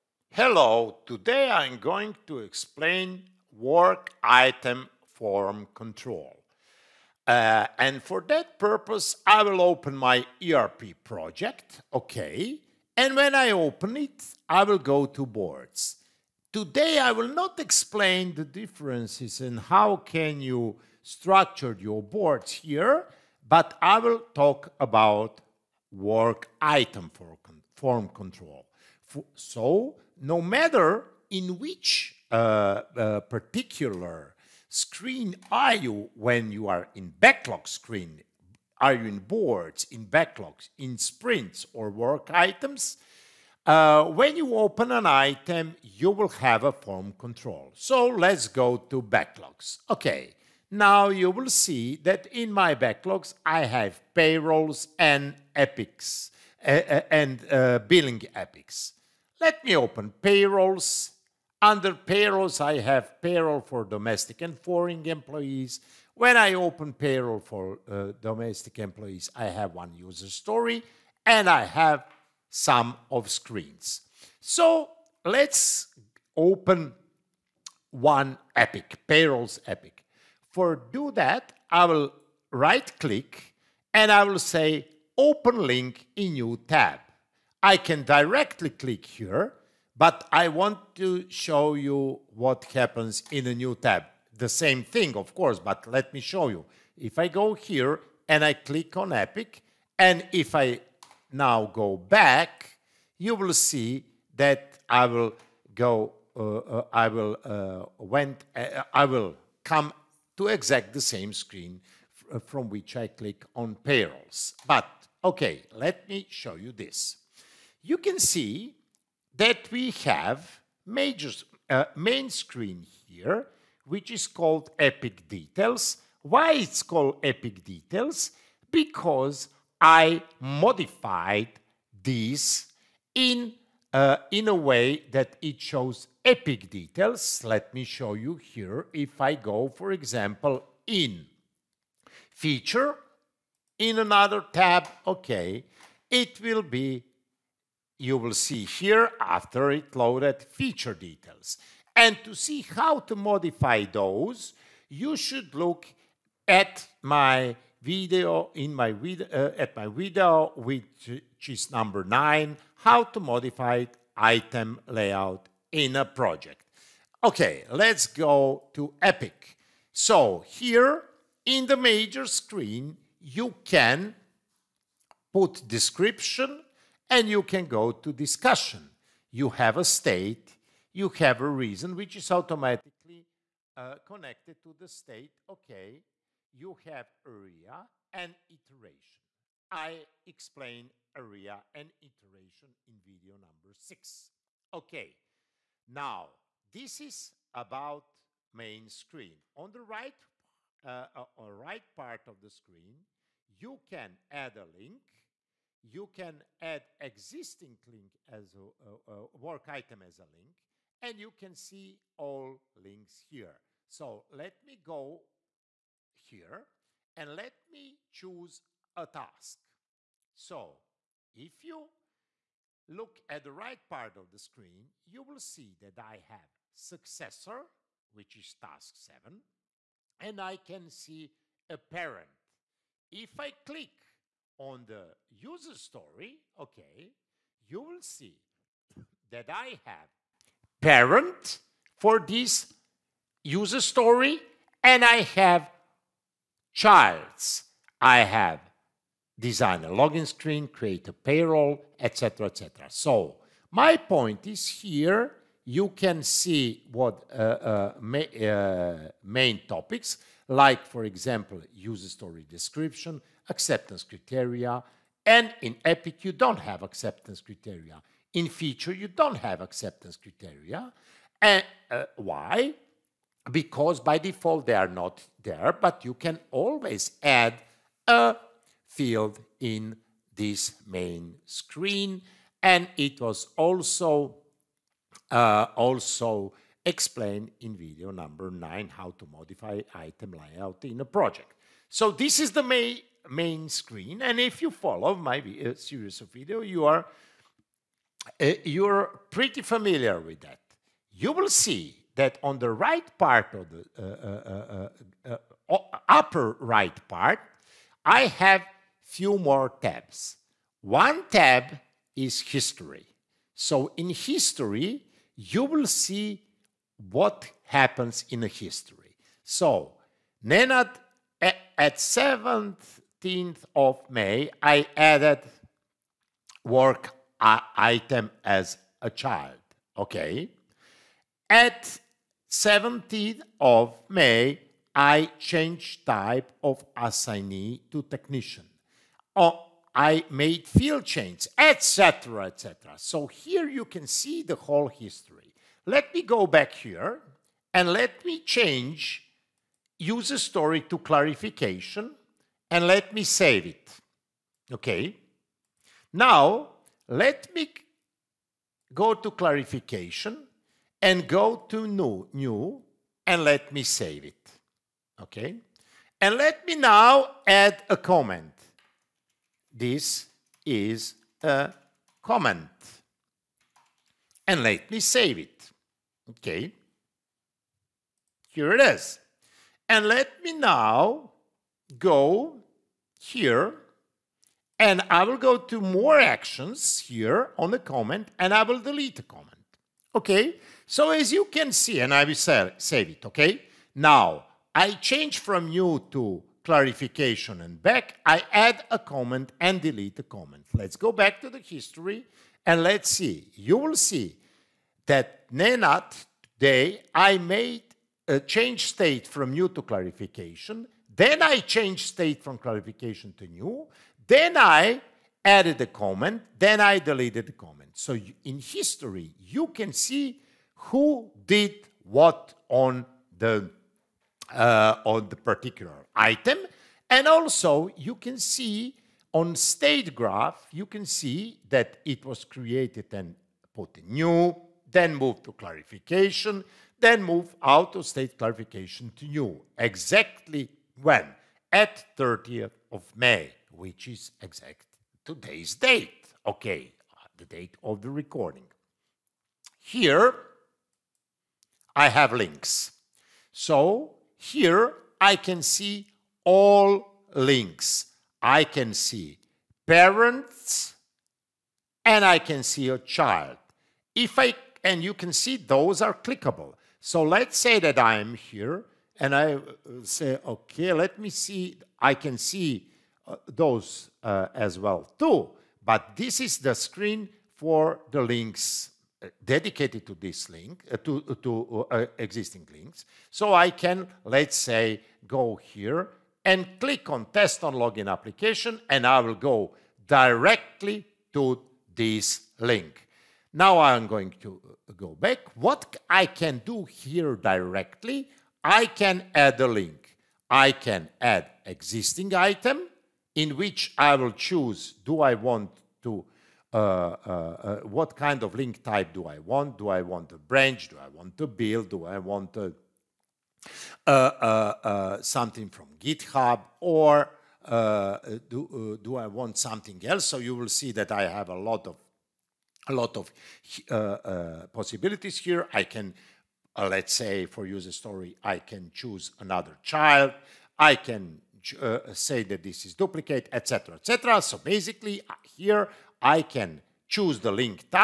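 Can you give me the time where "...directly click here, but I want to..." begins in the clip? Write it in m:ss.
1:28.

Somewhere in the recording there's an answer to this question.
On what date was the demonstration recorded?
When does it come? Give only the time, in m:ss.
7:22.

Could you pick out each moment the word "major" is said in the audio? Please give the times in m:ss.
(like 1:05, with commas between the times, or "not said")
2:00, 2:51.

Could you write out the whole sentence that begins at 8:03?
So I can, let's say, go here and click on test on login application and I will go directly to this link.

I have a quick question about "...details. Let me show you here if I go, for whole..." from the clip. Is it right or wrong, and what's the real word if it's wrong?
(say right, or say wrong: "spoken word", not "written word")
wrong: "example", not "whole".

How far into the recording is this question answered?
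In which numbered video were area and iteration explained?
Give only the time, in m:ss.
3:12.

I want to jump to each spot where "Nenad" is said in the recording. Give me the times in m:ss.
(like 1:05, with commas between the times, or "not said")
5:20, 6:45.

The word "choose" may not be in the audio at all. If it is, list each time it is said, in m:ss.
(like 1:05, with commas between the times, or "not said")
3:38, 8:24, 8:48, 8:57.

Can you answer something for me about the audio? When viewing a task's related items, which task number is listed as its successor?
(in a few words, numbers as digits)
task 7.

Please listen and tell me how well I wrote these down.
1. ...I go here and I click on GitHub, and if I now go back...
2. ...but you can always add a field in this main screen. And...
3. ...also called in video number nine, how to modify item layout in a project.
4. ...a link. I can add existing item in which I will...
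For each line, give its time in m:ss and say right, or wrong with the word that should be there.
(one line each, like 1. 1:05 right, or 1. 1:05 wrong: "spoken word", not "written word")
1. 1:37 wrong: "Epic", not "GitHub"
2. 4:35 right
3. 4:45 wrong: "explained", not "called"
4. 8:19 right.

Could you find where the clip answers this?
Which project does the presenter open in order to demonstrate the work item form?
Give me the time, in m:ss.
0:10.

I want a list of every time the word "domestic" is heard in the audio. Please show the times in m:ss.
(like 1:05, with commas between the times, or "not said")
1:03, 1:08.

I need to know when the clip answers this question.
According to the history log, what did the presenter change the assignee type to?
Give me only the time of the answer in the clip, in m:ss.
5:38.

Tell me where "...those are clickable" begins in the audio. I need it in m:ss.
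7:45.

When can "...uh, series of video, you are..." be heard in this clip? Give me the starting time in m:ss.
4:55.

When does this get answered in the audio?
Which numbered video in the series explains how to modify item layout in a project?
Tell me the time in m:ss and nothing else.
2:41.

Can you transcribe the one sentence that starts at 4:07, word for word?
I have design a login screen, create a payroll, etc., etc.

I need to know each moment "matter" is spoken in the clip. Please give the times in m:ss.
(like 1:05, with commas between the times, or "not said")
0:30.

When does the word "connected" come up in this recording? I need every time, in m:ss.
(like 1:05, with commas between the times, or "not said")
3:03.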